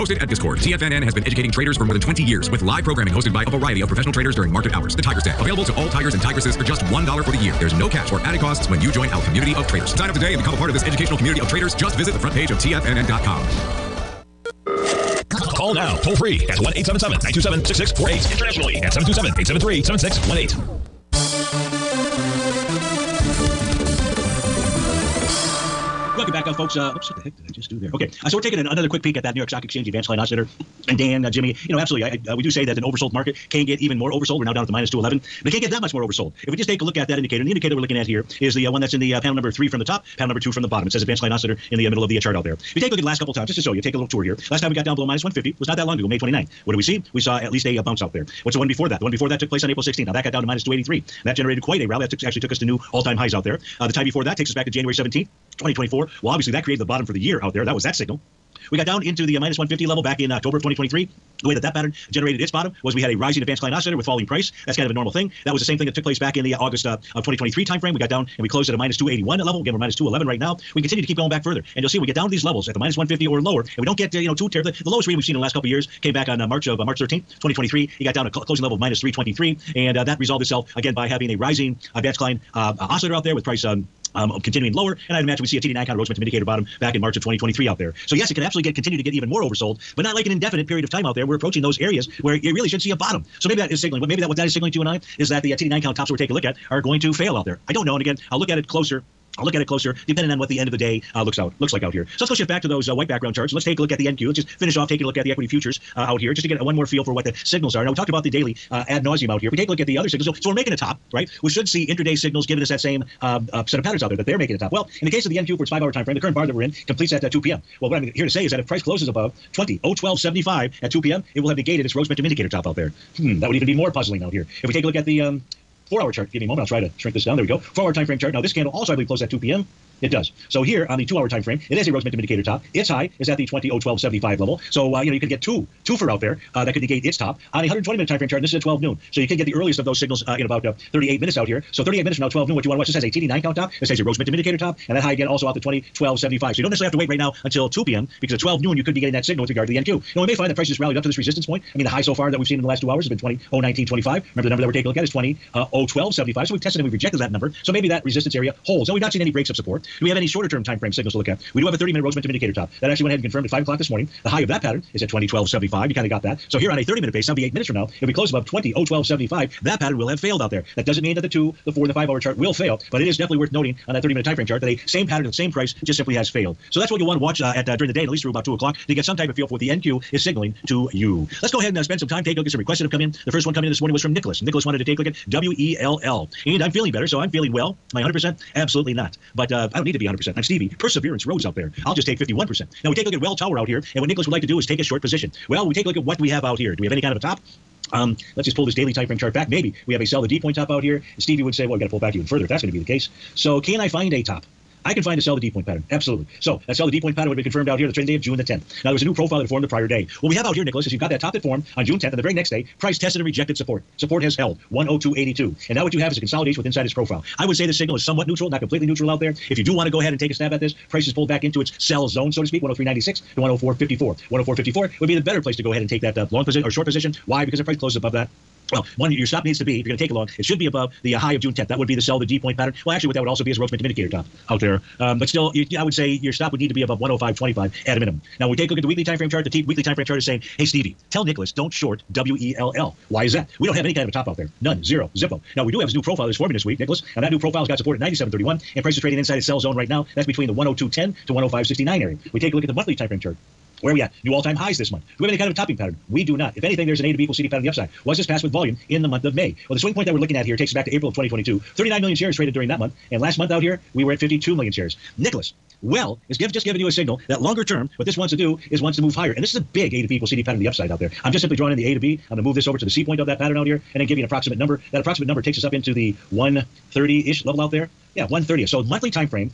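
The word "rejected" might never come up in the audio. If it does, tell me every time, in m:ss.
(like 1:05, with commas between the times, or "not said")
2:36, 3:33.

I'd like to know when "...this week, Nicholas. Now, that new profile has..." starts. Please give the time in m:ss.
4:06.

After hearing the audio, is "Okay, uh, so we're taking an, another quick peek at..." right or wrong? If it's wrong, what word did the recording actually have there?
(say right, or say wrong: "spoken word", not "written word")
right.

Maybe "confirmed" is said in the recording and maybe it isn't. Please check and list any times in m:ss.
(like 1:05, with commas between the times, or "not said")
2:43, 3:27.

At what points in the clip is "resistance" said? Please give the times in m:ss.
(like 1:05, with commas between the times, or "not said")
2:31, 2:38.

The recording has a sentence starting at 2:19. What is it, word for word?
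So you can get the earliest of those signals uh, in about uh, 38 minutes out here.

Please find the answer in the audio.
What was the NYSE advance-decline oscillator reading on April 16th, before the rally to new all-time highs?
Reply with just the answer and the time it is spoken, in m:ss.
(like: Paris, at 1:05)
-283, at 0:50.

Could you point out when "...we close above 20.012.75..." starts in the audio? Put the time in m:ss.
2:48.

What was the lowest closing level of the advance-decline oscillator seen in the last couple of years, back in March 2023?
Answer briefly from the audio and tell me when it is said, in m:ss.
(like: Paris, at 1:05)
-323, at 1:18.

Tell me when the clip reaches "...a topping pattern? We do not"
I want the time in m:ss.
4:15.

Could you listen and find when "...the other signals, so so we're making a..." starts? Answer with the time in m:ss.
1:49.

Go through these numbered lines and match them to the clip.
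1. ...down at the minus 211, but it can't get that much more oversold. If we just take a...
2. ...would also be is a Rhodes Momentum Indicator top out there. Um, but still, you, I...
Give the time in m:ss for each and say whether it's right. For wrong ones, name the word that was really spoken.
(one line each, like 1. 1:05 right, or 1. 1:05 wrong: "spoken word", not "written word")
1. 0:34 right
2. 3:53 right.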